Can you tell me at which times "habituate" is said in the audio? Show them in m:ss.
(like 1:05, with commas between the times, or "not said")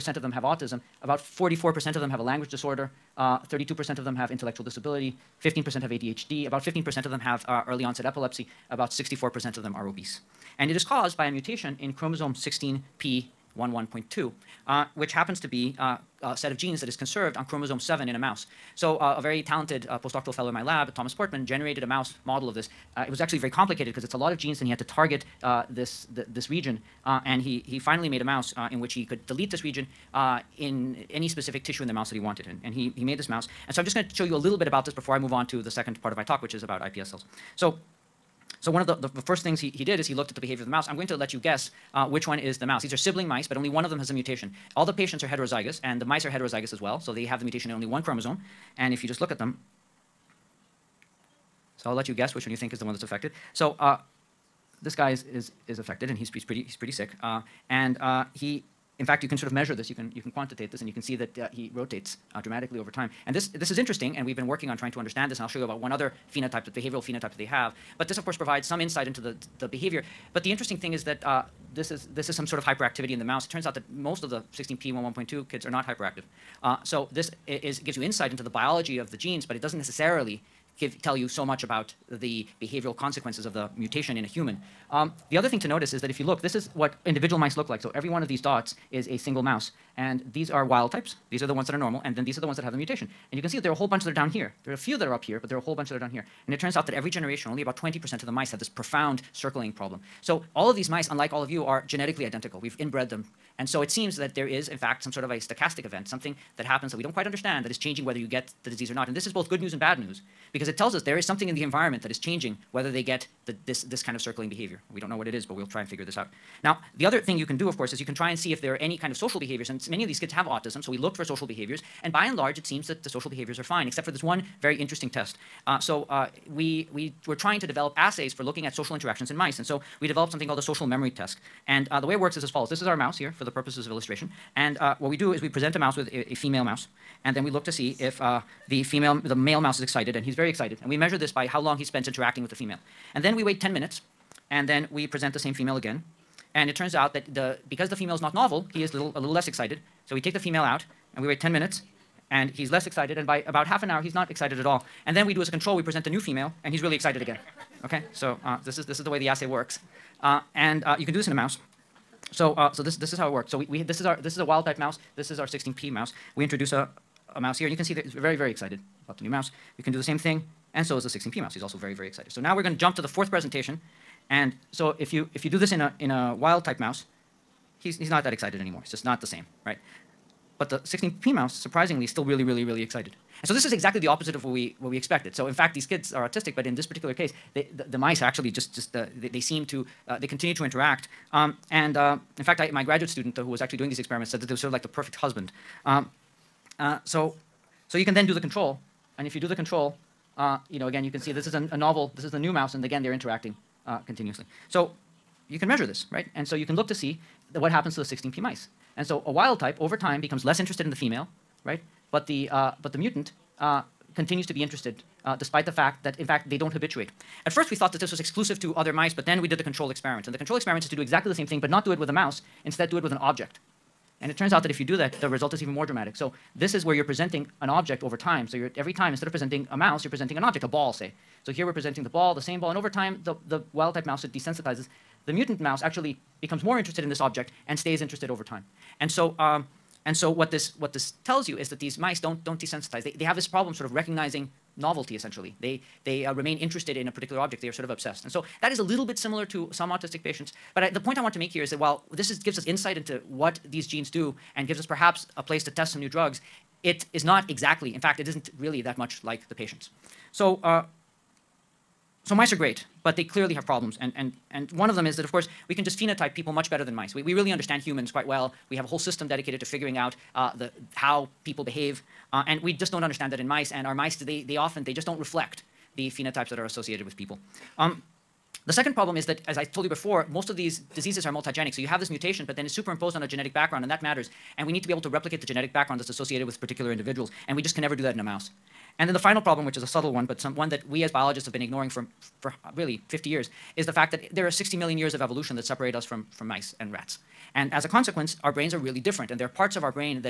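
3:36.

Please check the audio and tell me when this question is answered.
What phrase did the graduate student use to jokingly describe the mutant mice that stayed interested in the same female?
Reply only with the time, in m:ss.
3:14.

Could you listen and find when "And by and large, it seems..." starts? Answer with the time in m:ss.
2:02.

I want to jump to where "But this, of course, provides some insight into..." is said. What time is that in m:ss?
1:07.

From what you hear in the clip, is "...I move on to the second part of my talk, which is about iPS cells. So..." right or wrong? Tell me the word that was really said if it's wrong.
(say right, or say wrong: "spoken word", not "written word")
right.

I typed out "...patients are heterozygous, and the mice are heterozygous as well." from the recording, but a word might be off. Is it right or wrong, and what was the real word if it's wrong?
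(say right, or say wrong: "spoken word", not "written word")
right.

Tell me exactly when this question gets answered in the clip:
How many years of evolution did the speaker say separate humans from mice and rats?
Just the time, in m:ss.
4:54.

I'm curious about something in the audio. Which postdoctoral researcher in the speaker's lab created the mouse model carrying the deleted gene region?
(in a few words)
Thomas Portmann.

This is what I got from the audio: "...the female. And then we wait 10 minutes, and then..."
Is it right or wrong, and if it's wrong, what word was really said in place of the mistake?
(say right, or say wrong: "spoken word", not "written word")
right.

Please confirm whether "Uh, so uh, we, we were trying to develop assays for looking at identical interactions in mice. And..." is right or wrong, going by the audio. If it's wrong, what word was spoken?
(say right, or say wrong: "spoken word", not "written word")
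wrong: "social", not "identical".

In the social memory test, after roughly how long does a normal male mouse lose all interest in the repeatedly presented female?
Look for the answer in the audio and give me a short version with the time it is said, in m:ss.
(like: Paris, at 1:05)
Half an hour, at 2:33.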